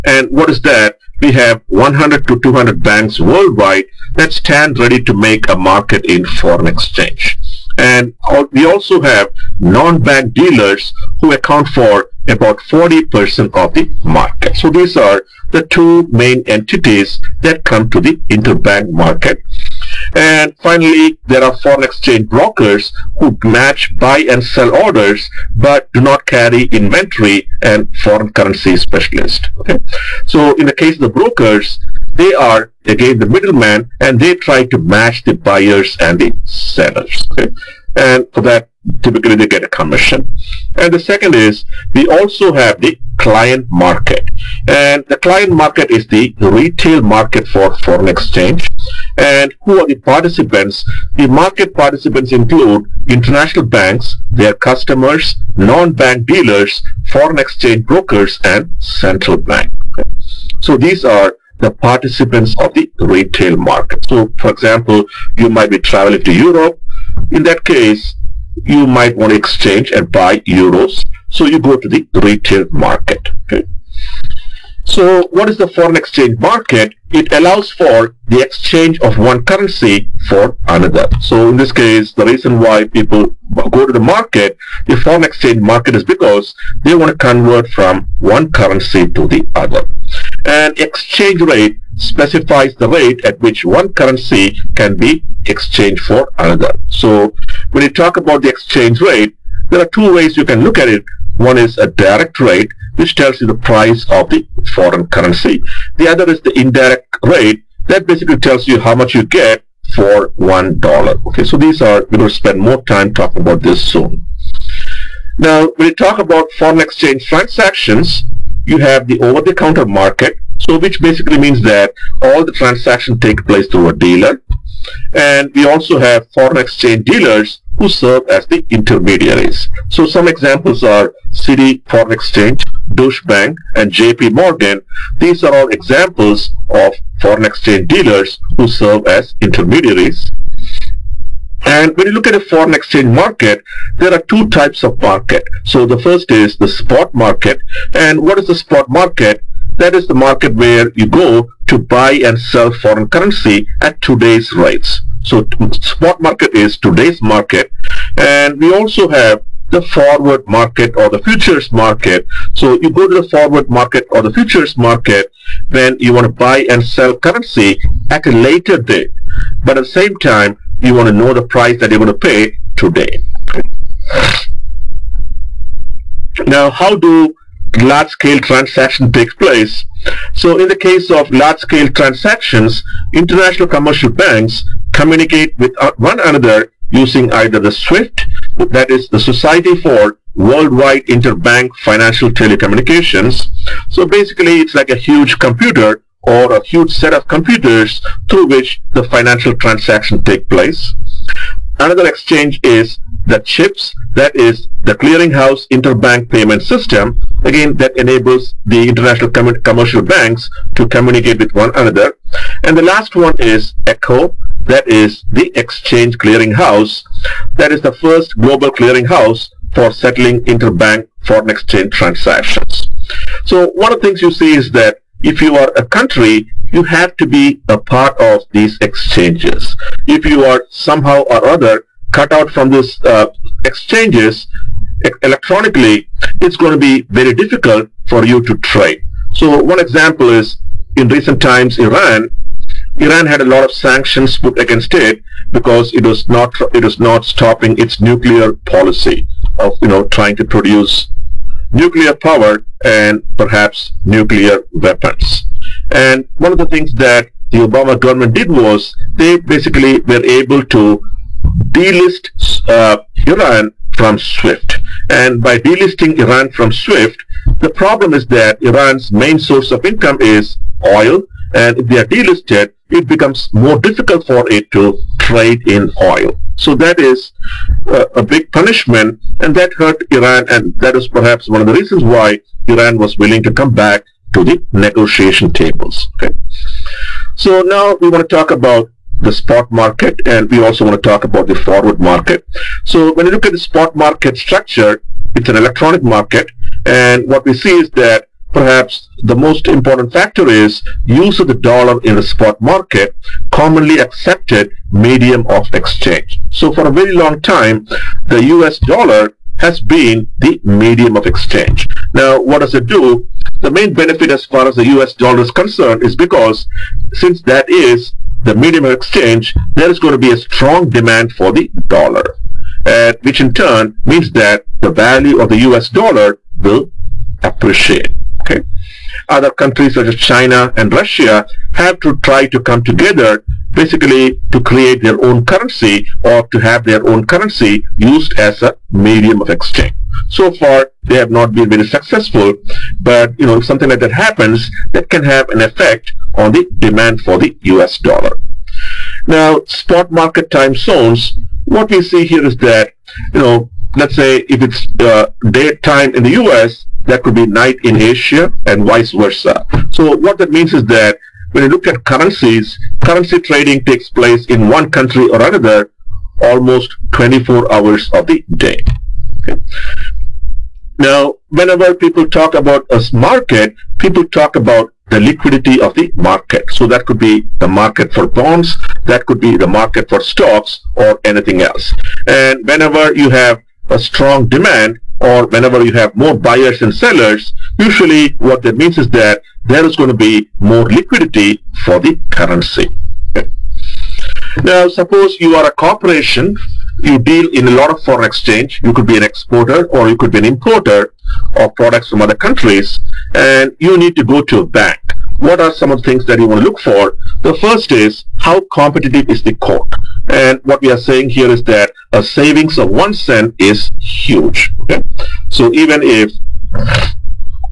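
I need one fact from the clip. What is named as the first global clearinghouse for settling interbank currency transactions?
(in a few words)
ECHO.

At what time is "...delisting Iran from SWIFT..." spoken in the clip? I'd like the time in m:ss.
4:25.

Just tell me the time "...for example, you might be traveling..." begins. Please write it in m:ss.
1:04.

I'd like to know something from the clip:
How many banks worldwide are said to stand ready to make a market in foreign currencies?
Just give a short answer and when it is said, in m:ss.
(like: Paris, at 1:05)
100 to 200, at 0:01.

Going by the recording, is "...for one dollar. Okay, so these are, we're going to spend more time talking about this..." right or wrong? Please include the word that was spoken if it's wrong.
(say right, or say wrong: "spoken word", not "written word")
right.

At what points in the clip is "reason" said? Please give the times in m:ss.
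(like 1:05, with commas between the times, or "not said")
1:22, 4:41.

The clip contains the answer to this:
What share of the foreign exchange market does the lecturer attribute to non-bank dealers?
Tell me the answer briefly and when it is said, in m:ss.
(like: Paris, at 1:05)
40%, at 0:12.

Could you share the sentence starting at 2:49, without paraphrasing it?
But at the same time, you want to know the price that you're going to pay today.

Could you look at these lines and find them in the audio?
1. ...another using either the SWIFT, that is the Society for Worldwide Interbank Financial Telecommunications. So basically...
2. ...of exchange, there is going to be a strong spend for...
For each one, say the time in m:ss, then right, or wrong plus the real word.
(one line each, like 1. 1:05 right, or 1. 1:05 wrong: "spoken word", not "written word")
1. 3:06 right
2. 5:18 wrong: "demand", not "spend".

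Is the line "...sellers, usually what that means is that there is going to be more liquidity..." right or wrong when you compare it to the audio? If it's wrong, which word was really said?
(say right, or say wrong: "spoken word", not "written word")
right.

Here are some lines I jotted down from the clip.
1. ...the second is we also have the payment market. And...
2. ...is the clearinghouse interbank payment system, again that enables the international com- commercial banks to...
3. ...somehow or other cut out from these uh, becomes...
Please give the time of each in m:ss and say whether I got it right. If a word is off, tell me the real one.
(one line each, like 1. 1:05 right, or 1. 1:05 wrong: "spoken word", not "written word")
1. 0:40 wrong: "client", not "payment"
2. 3:24 right
3. 3:50 wrong: "exchanges", not "becomes".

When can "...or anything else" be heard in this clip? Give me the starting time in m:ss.
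6:20.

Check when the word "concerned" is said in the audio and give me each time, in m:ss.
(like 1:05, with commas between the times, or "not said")
5:15.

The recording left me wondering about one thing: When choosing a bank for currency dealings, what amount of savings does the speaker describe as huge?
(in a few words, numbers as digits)
one cent.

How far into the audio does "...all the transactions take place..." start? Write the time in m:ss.
2:02.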